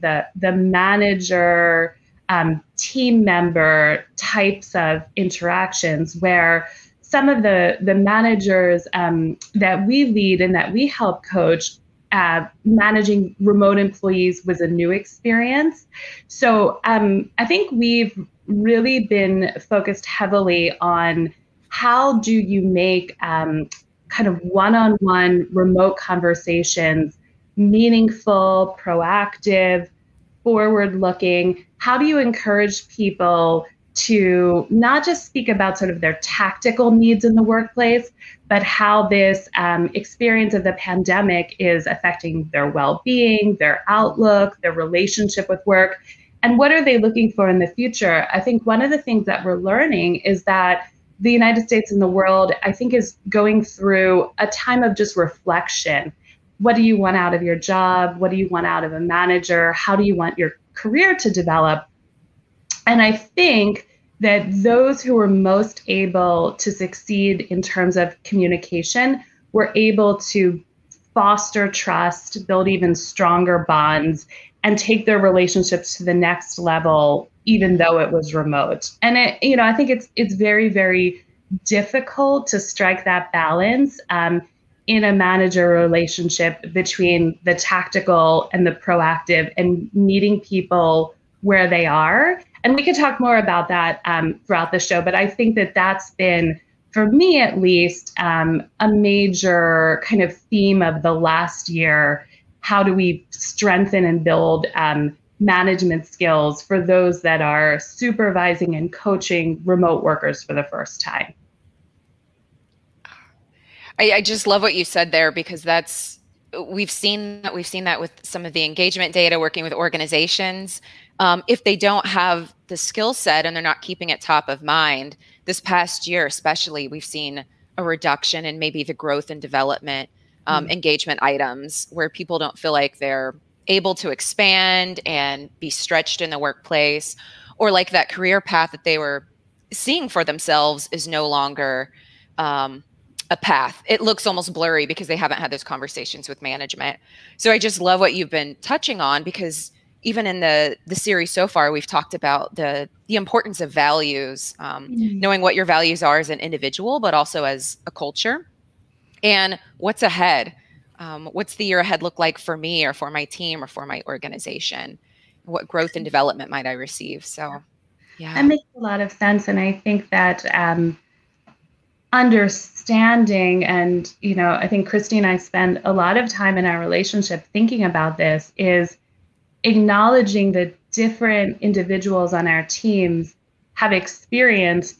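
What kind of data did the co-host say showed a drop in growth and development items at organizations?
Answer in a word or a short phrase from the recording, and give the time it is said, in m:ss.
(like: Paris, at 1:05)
engagement data, at 1:58.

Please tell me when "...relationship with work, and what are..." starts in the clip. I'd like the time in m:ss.
0:44.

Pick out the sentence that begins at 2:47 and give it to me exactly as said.
So, yeah, that makes a lot of sense, and I think that.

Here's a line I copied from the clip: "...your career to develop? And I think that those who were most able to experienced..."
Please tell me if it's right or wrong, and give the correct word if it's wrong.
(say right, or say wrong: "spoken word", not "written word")
wrong: "succeed", not "experienced".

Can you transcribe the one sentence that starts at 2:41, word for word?
Um, what's the year ahead look like for me, or for my team, or for my organization?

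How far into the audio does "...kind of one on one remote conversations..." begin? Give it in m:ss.
0:24.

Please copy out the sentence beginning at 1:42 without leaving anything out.
How do we strengthen and build um, management skills for those that are supervising and coaching remote workers for the first time?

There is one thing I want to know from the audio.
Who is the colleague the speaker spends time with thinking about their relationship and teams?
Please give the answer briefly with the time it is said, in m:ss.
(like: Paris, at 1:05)
Christy, at 2:54.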